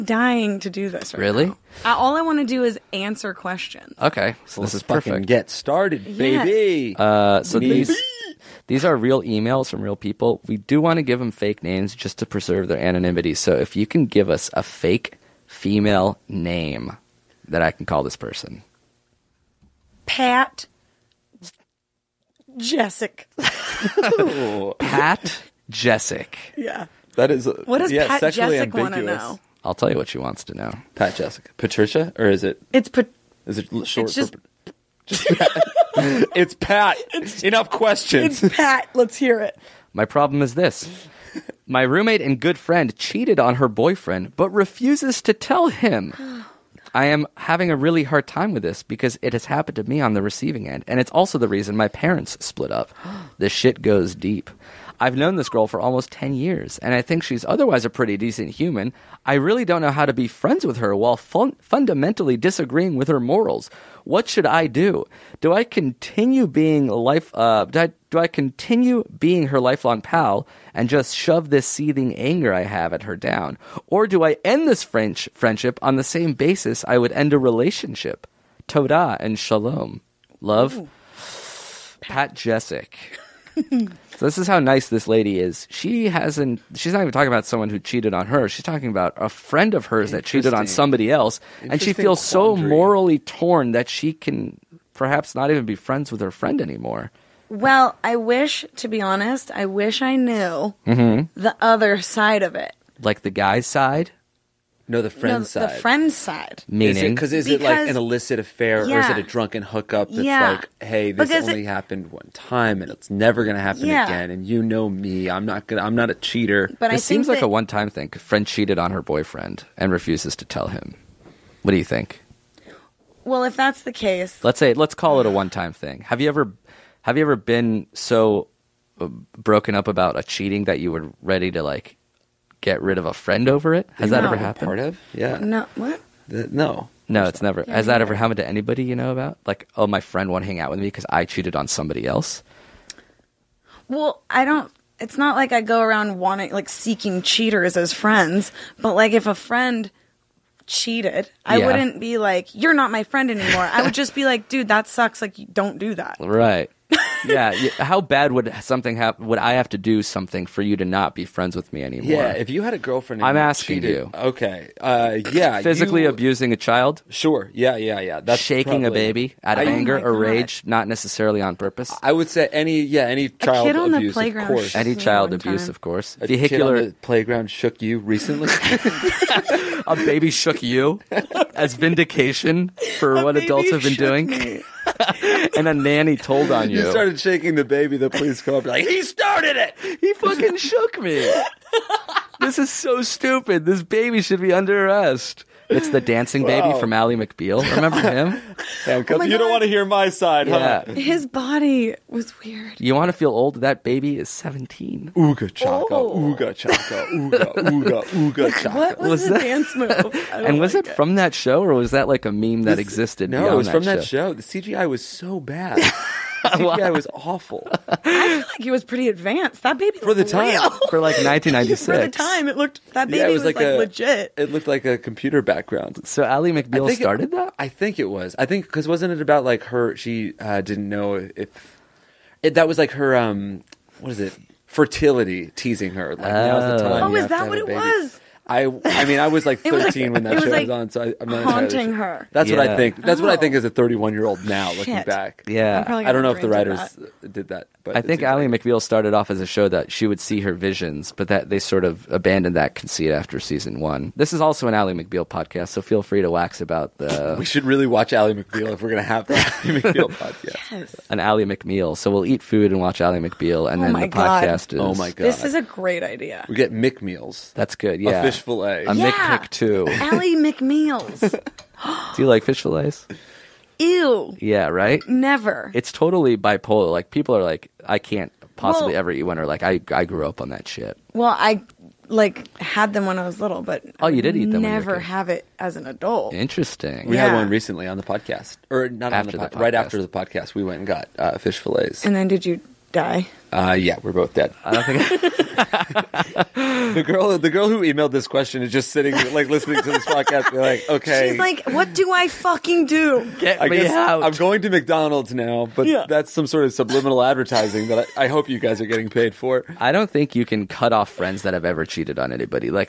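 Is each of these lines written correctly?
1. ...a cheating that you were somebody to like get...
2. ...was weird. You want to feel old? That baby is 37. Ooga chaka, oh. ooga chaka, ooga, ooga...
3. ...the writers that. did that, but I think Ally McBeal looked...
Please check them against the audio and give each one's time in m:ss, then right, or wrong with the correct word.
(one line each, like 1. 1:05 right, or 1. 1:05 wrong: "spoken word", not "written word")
1. 2:10 wrong: "ready", not "somebody"
2. 3:22 wrong: "17", not "37"
3. 4:06 wrong: "started", not "looked".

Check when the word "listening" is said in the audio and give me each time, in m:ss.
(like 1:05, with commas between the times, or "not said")
4:59.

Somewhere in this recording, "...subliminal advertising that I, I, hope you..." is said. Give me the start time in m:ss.
5:06.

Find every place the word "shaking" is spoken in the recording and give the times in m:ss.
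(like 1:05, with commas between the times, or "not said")
2:48, 3:07.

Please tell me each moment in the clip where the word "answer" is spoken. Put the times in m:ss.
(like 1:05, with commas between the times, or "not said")
0:02.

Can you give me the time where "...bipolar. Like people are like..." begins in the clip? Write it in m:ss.
4:36.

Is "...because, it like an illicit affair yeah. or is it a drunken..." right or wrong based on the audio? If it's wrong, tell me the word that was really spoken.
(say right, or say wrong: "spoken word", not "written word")
right.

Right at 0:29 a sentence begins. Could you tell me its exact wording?
I'll tell you what she wants to know.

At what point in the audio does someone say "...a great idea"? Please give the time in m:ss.
4:25.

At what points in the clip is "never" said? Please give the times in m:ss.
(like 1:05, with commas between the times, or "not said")
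1:53, 2:17, 4:35, 4:44.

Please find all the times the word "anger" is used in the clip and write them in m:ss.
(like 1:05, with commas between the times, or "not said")
1:12, 2:49.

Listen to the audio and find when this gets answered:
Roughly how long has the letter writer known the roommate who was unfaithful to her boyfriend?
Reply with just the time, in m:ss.
0:55.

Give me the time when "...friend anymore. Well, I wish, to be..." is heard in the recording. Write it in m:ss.
1:36.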